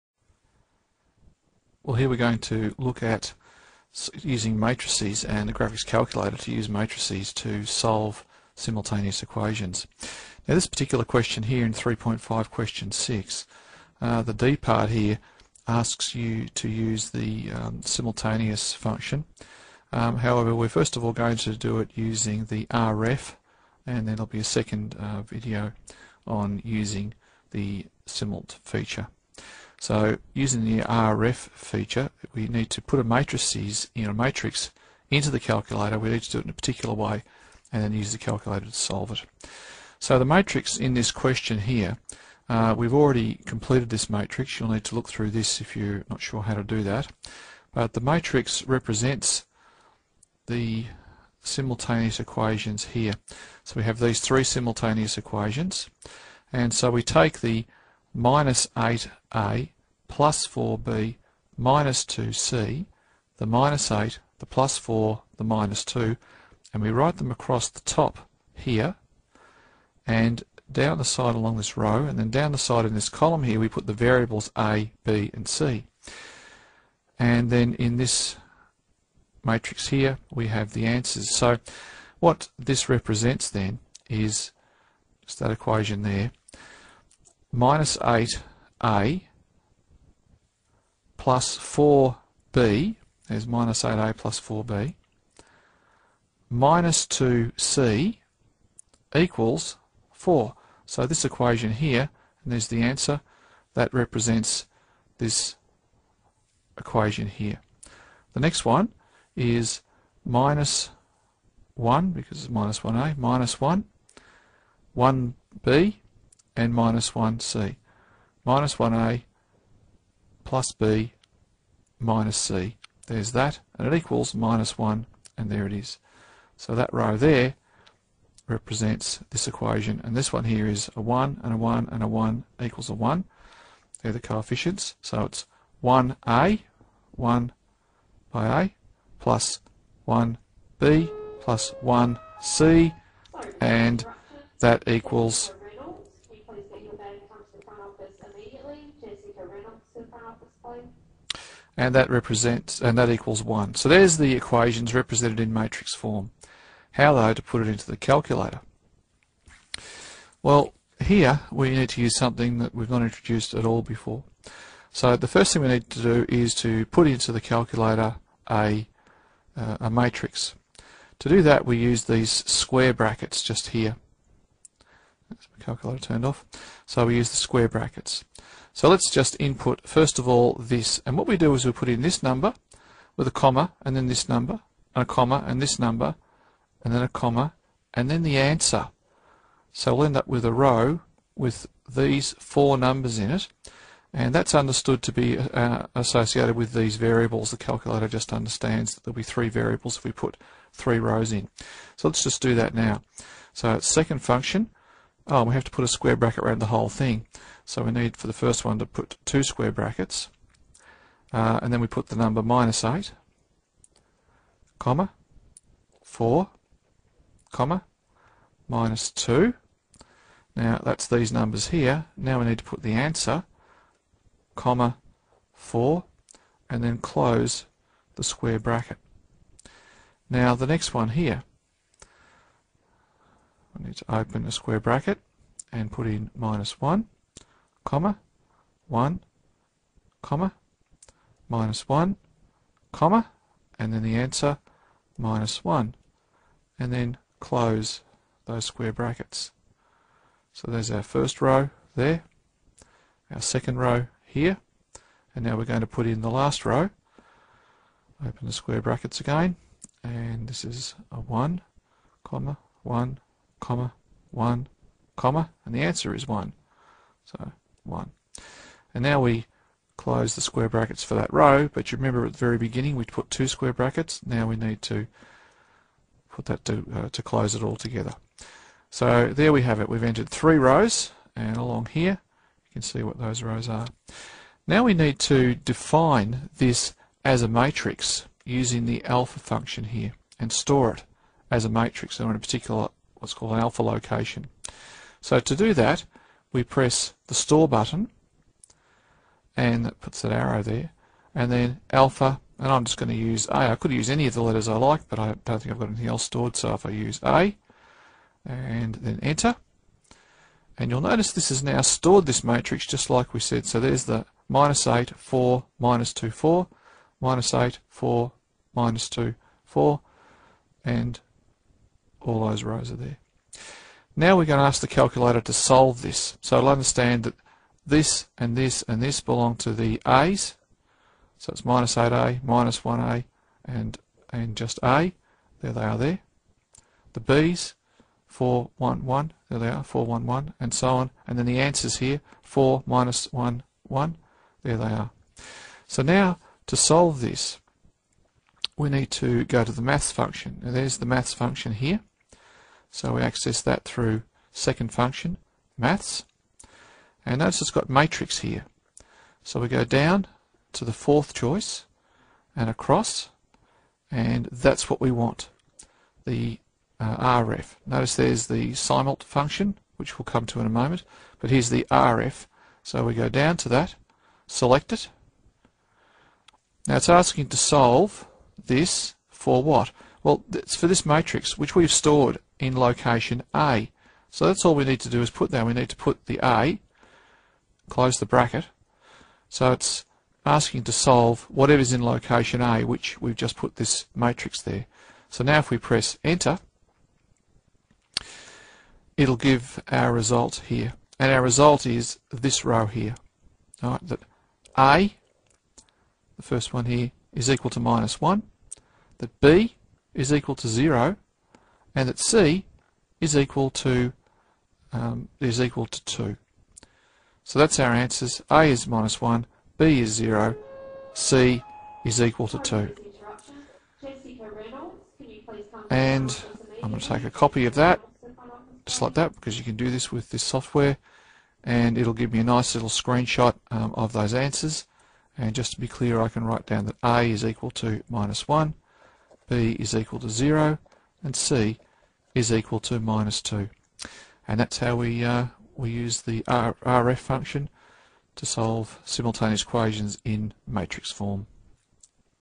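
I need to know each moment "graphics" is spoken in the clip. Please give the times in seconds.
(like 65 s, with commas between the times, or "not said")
5 s.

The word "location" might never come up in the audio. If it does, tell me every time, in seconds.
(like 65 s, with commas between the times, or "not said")
293 s, 382 s, 392 s.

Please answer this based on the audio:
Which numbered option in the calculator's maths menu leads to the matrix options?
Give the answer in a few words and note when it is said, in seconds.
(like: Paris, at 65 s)
fourth, at 360 s.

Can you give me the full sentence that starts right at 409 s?
That B is equal to 0 and that C is equal to um, is equal to 2.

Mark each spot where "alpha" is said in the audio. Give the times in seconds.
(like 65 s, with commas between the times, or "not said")
289 s, 293 s, 301 s.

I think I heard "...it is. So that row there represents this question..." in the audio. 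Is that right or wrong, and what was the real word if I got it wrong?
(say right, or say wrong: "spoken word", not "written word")
wrong: "equation", not "question".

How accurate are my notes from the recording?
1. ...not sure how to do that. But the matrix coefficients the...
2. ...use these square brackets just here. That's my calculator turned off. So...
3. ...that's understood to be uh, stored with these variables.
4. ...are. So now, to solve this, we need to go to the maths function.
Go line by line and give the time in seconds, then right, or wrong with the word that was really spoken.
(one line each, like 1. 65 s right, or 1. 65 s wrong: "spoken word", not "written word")
1. 46 s wrong: "represents", not "coefficients"
2. 171 s right
3. 194 s wrong: "associated", not "stored"
4. 344 s right.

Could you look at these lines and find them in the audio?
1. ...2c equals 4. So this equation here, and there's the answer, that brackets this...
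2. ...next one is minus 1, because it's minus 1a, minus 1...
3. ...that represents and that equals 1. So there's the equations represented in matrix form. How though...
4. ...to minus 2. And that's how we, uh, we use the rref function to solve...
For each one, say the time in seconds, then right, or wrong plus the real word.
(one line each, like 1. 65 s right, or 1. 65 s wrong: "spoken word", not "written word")
1. 97 s wrong: "represents", not "brackets"
2. 108 s right
3. 151 s right
4. 442 s right.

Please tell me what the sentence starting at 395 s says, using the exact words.
So now if we press enter, it'll give our result here.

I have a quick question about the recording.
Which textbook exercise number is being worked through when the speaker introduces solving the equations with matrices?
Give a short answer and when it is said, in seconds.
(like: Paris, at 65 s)
3.5 question 6, at 11 s.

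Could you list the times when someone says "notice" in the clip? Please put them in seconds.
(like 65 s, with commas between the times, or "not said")
311 s, 357 s, 367 s.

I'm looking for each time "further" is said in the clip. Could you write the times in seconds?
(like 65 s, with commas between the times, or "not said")
not said.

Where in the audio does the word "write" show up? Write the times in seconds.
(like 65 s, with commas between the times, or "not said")
66 s, 436 s.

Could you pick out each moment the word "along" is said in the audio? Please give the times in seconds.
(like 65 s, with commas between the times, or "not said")
71 s, 281 s.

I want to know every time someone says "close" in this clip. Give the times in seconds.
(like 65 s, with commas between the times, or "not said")
226 s, 247 s, 269 s, 277 s, 387 s.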